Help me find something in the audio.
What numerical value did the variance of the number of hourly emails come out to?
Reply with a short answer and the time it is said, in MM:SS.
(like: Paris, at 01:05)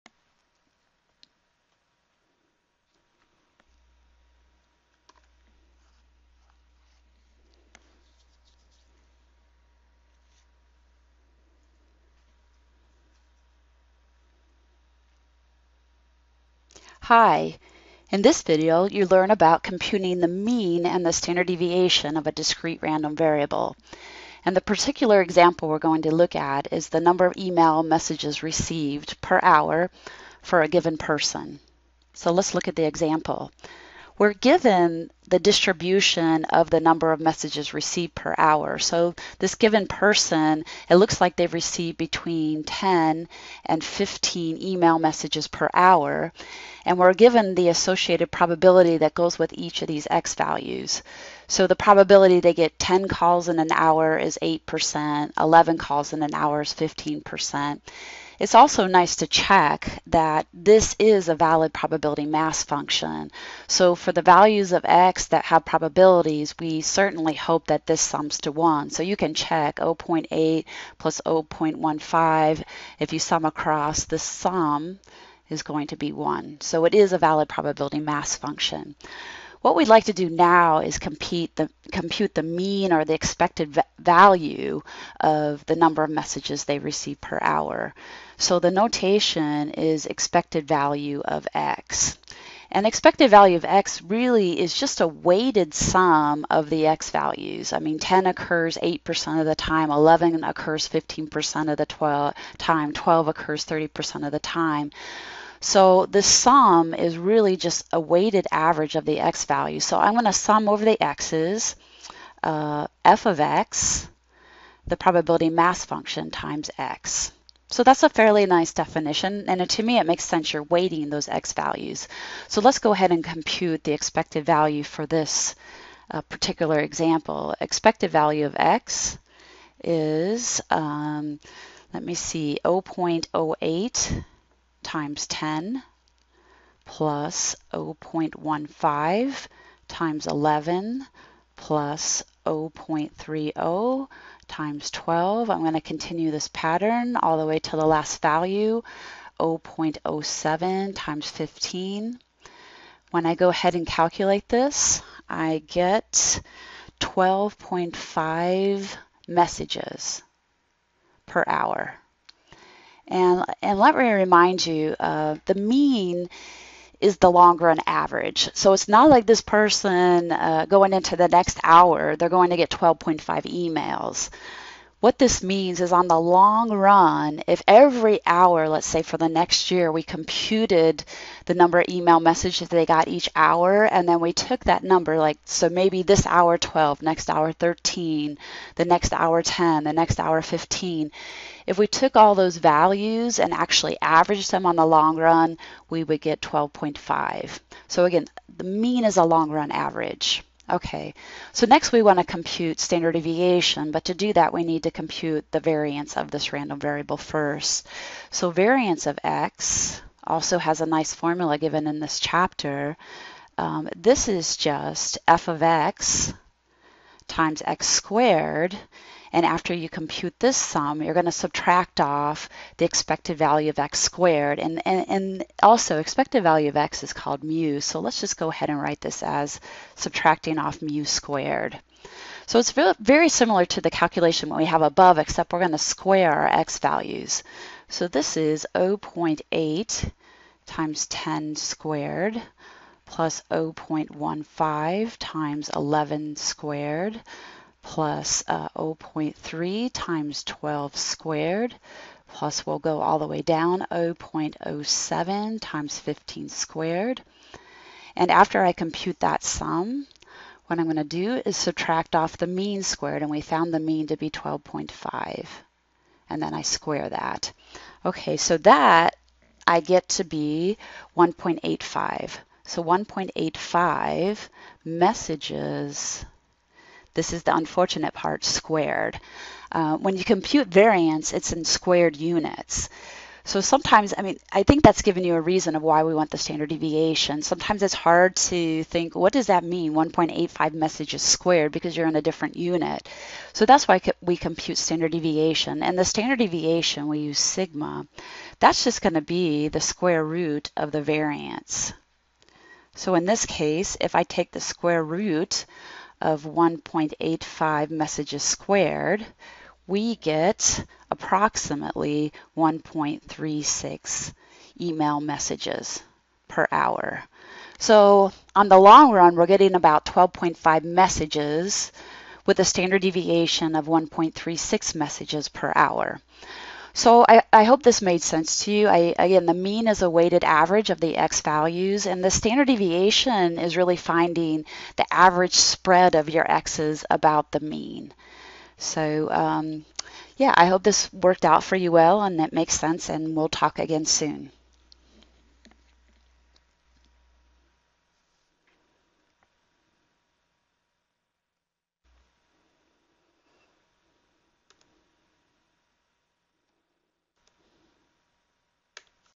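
1.85, at 04:28.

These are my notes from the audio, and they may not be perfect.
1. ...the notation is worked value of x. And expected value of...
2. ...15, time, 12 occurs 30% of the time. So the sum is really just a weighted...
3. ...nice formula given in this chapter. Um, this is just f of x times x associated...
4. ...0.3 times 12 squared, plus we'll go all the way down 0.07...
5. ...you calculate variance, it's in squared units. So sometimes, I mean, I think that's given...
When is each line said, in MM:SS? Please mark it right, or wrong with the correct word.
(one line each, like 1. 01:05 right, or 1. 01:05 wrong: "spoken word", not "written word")
1. 01:28 wrong: "expected", not "worked"
2. 01:41 wrong: "12", not "15"
3. 03:30 wrong: "squared", not "associated"
4. 04:08 right
5. 04:40 wrong: "compute", not "calculate".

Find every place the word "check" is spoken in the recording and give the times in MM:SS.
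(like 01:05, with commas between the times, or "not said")
00:59, 01:09.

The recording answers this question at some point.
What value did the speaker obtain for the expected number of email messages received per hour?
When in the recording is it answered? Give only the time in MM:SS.
02:35.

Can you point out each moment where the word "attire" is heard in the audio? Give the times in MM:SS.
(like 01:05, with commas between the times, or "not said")
not said.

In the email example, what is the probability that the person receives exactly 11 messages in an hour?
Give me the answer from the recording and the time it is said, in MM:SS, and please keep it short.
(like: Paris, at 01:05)
15%, at 00:55.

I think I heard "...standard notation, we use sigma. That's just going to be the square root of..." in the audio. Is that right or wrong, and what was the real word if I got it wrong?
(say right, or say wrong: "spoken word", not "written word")
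wrong: "deviation", not "notation".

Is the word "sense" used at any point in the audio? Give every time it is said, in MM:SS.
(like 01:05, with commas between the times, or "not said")
02:00, 05:28, 05:42.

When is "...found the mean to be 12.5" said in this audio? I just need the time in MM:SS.
04:23.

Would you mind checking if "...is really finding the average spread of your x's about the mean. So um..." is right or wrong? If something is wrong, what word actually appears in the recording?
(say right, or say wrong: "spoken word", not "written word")
right.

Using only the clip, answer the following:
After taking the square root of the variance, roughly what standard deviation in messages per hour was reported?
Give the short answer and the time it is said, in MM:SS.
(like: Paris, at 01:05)
1.36, at 05:11.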